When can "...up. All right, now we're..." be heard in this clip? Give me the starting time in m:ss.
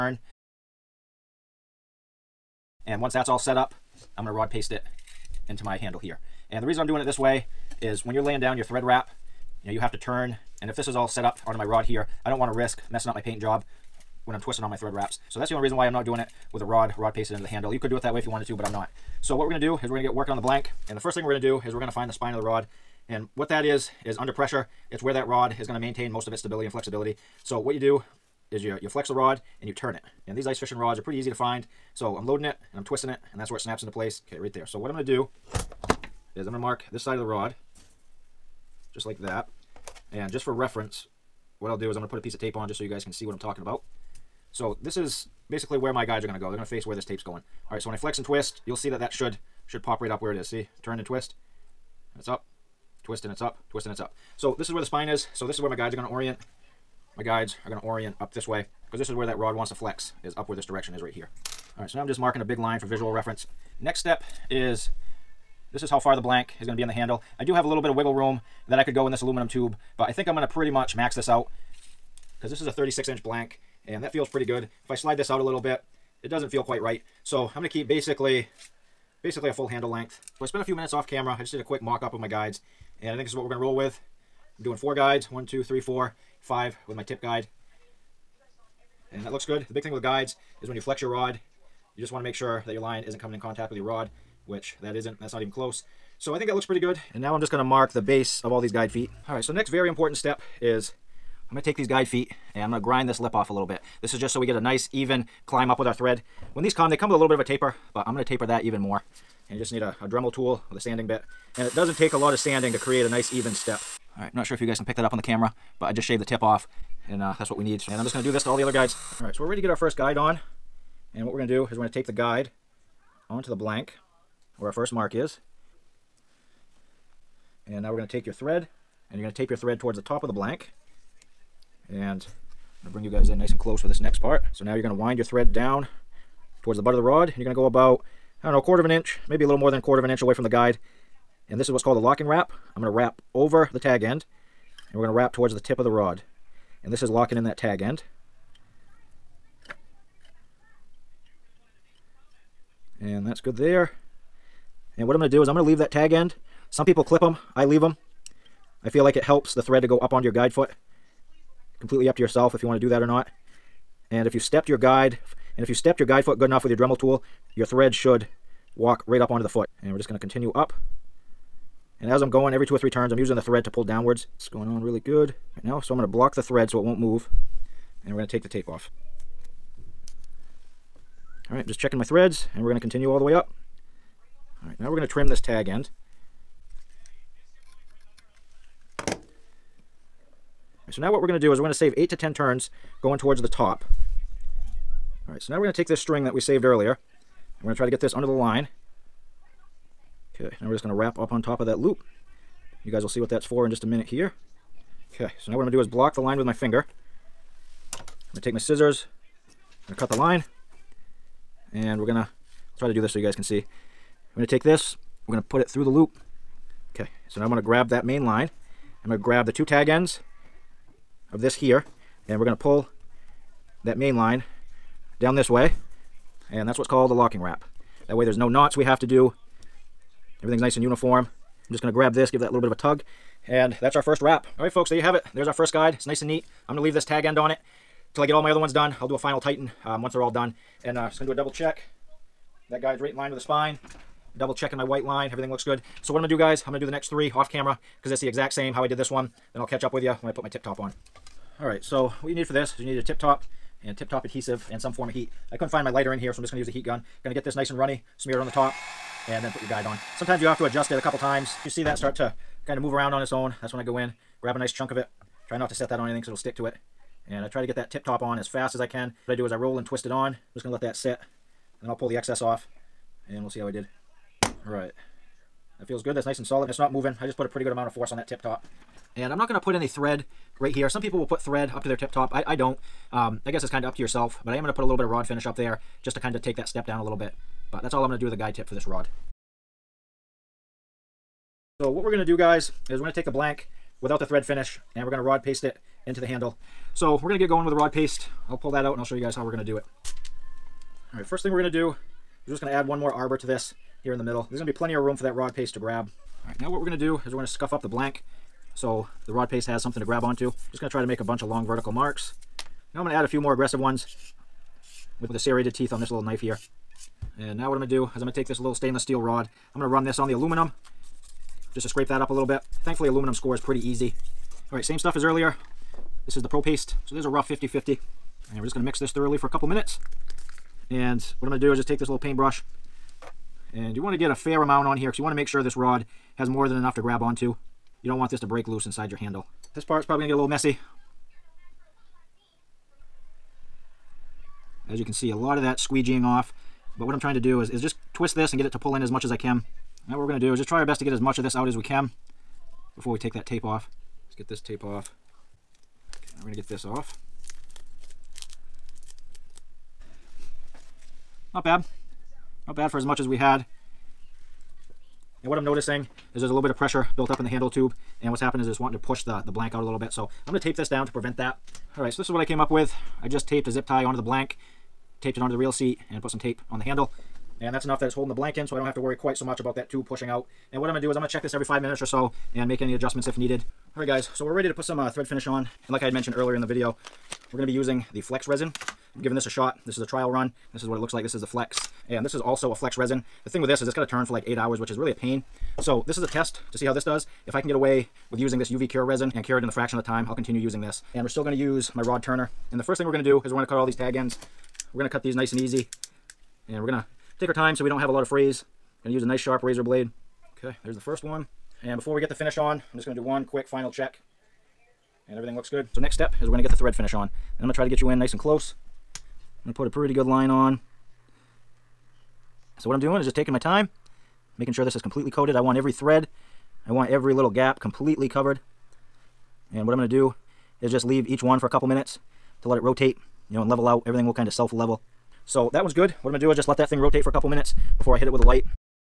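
3:03.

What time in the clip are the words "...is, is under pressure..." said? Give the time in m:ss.
0:23.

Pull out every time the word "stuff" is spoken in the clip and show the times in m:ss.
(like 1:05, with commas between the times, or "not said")
5:24.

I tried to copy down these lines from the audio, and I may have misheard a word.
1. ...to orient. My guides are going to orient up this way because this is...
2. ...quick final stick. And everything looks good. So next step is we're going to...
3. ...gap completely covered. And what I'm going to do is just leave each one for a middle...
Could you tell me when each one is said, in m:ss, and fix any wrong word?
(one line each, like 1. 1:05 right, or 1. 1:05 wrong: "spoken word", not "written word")
1. 0:56 right
2. 6:53 wrong: "check", not "stick"
3. 7:07 wrong: "couple", not "middle".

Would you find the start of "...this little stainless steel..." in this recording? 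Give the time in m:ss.
5:18.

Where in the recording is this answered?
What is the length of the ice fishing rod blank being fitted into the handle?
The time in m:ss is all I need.
1:12.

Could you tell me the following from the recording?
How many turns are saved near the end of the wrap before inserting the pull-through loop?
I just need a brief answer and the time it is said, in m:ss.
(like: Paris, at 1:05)
8 to 10, at 3:11.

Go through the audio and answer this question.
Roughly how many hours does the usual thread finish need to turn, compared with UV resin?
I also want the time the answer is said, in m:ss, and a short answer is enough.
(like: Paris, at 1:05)
8 hours, at 6:34.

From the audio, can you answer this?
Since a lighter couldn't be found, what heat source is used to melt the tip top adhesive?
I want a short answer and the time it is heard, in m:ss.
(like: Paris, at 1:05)
heat gun, at 4:16.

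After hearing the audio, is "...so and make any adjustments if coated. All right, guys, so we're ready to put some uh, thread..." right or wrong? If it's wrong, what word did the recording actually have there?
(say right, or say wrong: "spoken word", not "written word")
wrong: "needed", not "coated".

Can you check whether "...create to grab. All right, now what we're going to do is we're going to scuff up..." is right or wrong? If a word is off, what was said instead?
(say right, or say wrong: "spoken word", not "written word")
wrong: "paste", not "create".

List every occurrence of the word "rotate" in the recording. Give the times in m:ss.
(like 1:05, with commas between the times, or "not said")
7:12, 7:16.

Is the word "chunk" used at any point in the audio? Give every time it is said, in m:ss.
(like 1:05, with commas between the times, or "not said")
4:24.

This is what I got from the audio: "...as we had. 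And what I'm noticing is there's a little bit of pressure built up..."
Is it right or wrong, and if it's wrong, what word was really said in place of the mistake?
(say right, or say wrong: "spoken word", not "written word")
right.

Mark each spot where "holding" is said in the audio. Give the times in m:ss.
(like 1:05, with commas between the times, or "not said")
6:18.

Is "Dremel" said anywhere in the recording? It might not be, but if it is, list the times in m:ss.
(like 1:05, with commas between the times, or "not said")
1:50, 2:46.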